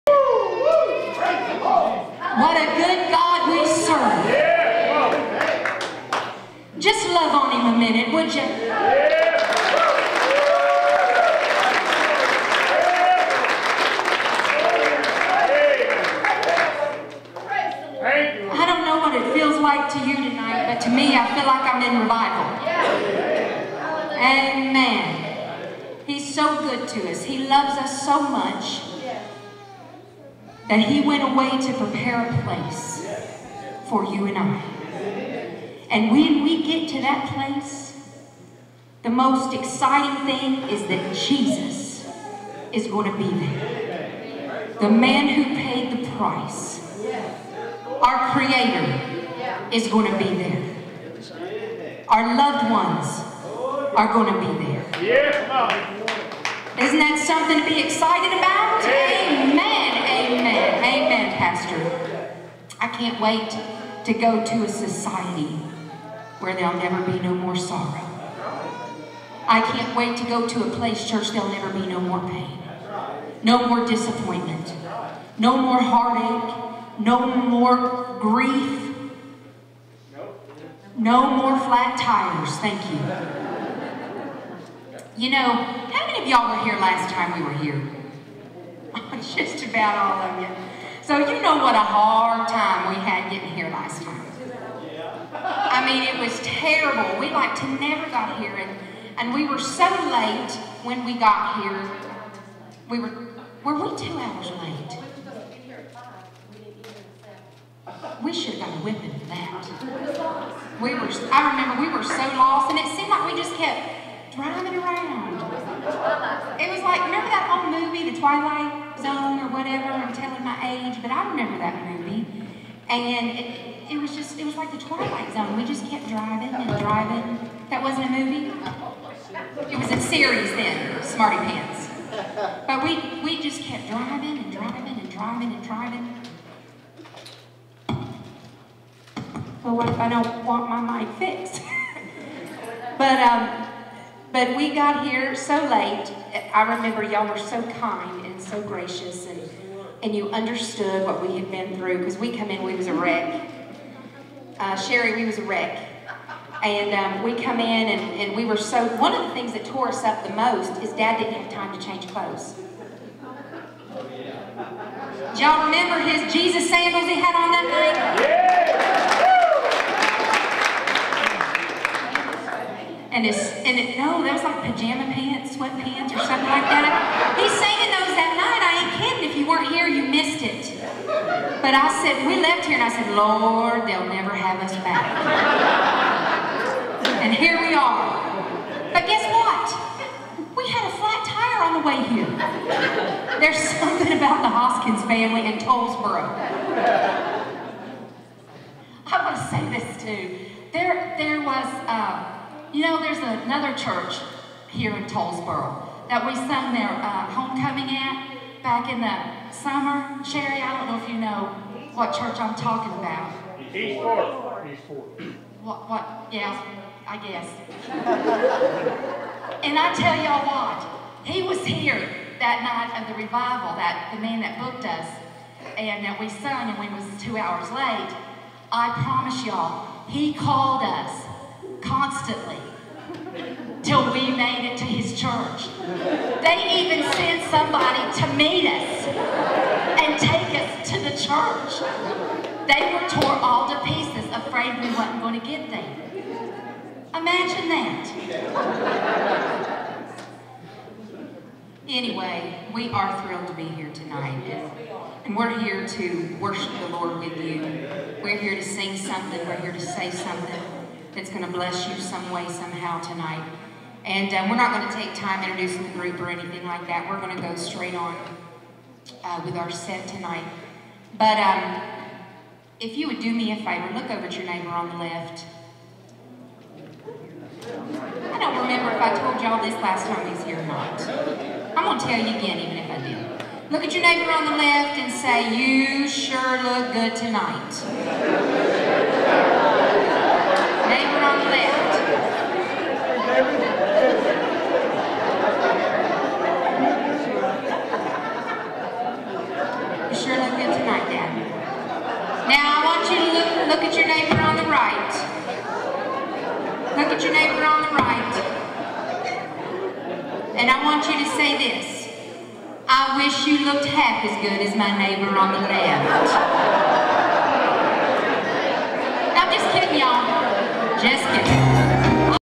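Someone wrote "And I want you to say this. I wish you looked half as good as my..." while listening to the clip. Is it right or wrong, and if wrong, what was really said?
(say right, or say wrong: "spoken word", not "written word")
right.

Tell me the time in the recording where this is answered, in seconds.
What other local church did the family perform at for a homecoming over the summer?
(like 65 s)
213 s.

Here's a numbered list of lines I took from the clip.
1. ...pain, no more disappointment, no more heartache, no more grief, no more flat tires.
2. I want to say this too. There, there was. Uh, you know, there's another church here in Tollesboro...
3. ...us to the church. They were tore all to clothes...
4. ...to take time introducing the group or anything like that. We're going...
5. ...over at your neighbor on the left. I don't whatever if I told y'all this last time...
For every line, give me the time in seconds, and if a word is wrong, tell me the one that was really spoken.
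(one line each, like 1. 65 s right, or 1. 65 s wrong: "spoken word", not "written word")
1. 72 s right
2. 199 s right
3. 240 s wrong: "pieces", not "clothes"
4. 264 s right
5. 274 s wrong: "remember", not "whatever".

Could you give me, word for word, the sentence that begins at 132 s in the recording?
But we, we just kept driving and driving and driving and driving.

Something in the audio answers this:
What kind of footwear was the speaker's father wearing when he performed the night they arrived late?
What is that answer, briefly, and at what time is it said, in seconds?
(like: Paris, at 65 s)
Jesus sandals, at 166 s.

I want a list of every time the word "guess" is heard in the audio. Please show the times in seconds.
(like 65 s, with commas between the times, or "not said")
189 s, 217 s.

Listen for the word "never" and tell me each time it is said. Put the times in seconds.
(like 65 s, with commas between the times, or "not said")
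66 s, 71 s, 97 s, 184 s.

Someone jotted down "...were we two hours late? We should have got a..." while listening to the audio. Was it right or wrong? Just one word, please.
right.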